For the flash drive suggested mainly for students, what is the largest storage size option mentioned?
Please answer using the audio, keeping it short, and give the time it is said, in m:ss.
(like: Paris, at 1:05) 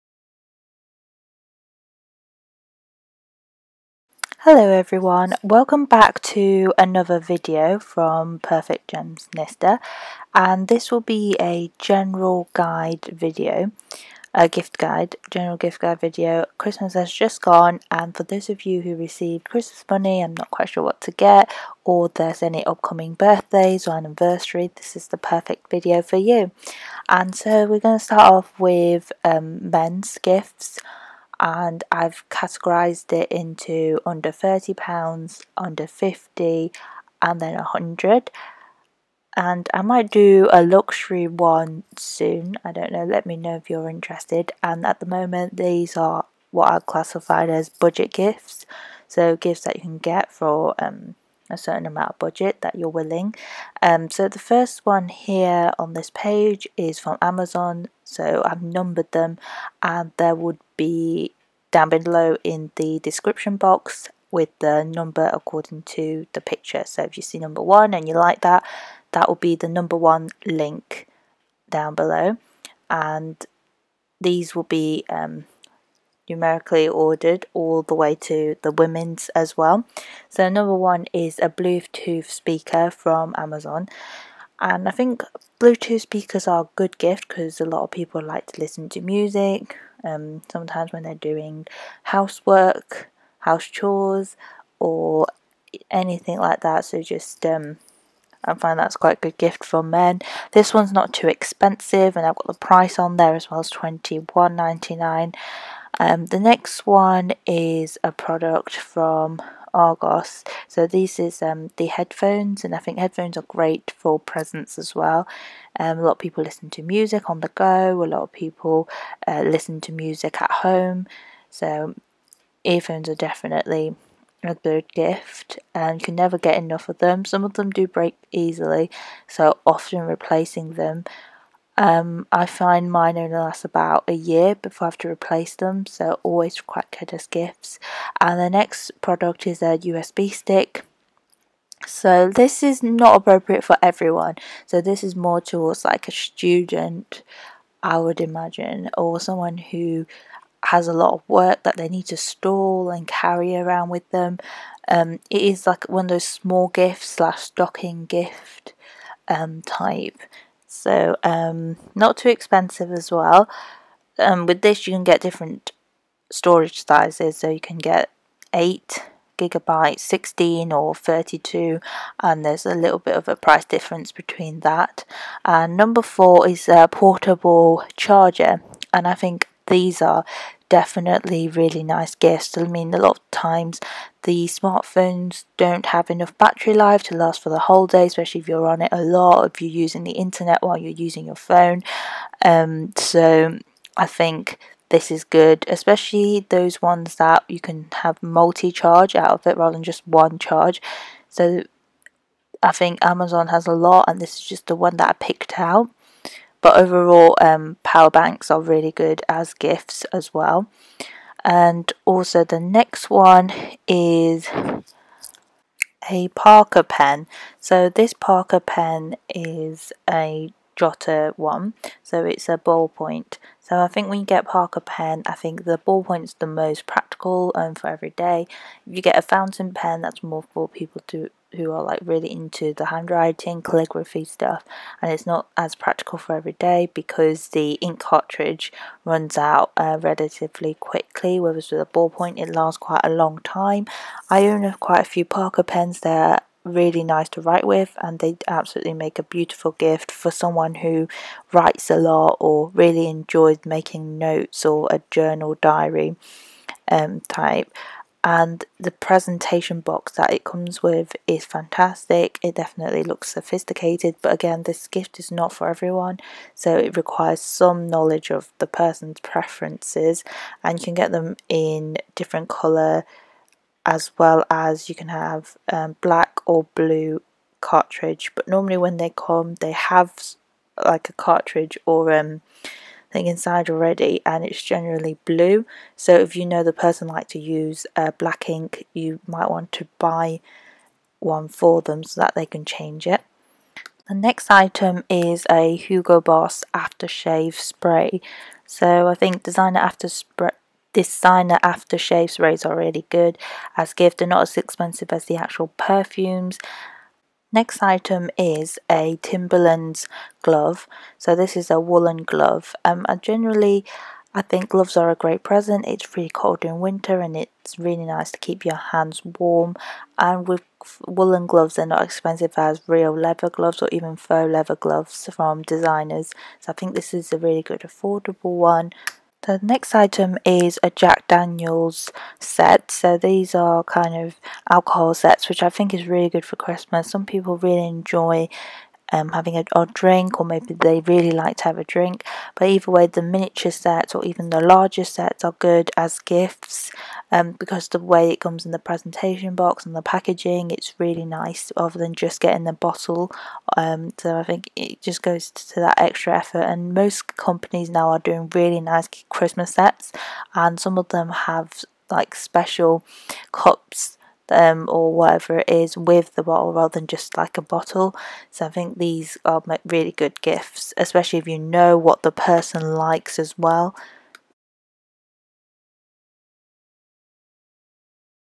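32 gigabytes, at 2:50.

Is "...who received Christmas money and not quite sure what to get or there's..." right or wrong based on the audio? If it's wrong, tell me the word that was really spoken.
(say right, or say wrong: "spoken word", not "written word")
right.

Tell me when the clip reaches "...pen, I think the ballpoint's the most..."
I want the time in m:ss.
3:44.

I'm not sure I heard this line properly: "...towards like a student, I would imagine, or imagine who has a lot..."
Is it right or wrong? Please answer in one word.
wrong.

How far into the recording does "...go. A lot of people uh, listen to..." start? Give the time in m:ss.
1:57.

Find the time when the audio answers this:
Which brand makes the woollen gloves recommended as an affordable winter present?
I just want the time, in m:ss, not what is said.
5:09.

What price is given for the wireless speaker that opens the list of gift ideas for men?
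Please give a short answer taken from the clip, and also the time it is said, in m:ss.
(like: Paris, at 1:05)
21.99, at 1:43.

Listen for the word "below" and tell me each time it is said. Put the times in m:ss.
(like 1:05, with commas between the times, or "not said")
1:01, 1:11.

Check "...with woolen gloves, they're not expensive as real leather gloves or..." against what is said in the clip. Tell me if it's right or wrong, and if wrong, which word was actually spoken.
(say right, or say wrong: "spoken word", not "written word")
right.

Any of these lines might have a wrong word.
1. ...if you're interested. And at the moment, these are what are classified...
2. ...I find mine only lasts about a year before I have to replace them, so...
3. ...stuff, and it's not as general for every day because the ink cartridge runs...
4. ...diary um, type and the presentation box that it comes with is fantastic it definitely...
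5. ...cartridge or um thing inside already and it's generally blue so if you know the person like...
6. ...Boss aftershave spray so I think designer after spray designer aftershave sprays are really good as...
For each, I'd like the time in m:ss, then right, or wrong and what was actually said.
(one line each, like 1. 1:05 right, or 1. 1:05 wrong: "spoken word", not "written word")
1. 0:43 right
2. 2:12 right
3. 3:54 wrong: "practical", not "general"
4. 4:15 right
5. 4:41 right
6. 4:56 right.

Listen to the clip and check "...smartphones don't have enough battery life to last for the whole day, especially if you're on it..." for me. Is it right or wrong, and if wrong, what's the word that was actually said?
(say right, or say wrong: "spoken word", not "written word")
right.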